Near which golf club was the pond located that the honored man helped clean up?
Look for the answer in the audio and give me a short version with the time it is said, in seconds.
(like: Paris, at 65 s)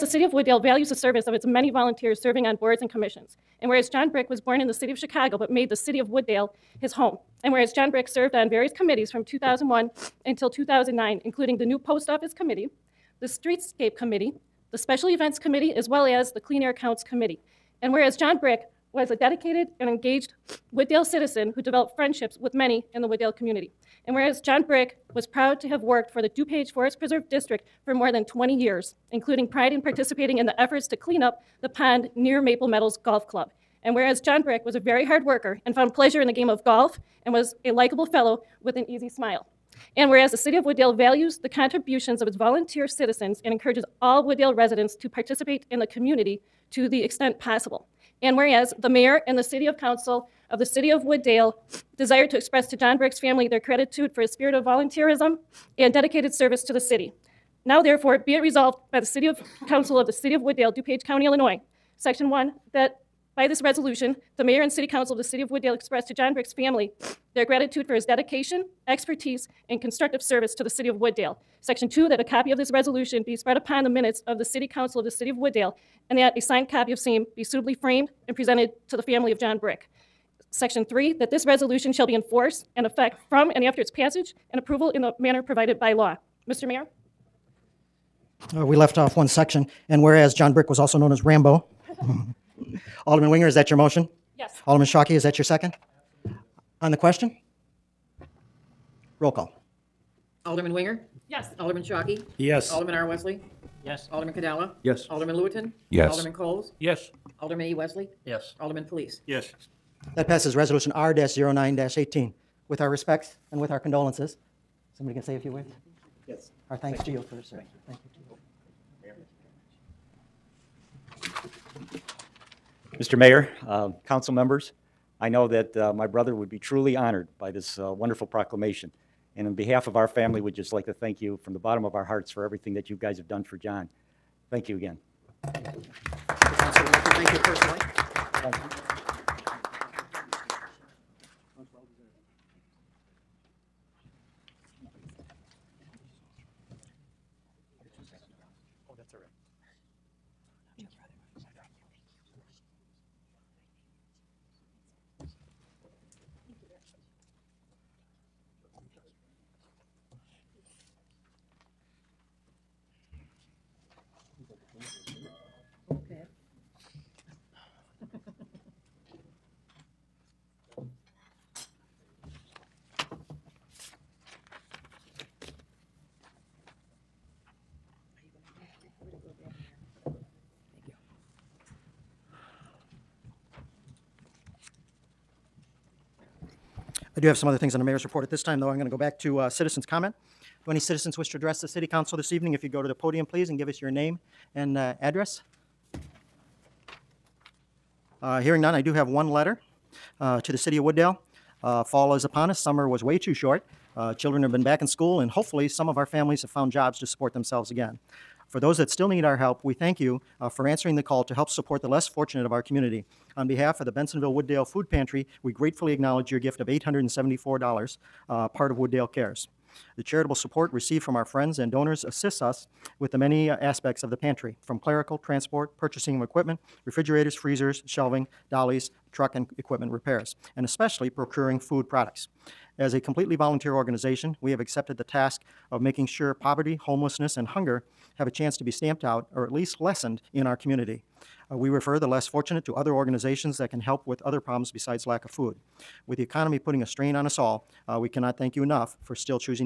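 Maple Meadows Golf Club, at 32 s.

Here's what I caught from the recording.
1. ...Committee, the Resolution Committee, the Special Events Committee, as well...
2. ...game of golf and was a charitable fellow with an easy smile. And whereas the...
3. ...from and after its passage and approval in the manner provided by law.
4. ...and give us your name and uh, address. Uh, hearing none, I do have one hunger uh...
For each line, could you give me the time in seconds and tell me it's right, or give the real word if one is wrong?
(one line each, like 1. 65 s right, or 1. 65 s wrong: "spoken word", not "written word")
1. 12 s wrong: "Streetscape", not "Resolution"
2. 36 s wrong: "likable", not "charitable"
3. 83 s right
4. 193 s wrong: "letter", not "hunger".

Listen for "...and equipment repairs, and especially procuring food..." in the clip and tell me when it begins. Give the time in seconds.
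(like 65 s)
229 s.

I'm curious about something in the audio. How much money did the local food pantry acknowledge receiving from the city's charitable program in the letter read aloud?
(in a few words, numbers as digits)
$874.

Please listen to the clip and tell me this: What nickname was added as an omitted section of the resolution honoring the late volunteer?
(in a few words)
Rambo.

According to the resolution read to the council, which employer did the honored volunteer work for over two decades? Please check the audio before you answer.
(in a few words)
DuPage Forest Preserve District.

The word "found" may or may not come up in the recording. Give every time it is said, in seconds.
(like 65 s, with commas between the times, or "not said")
35 s, 206 s.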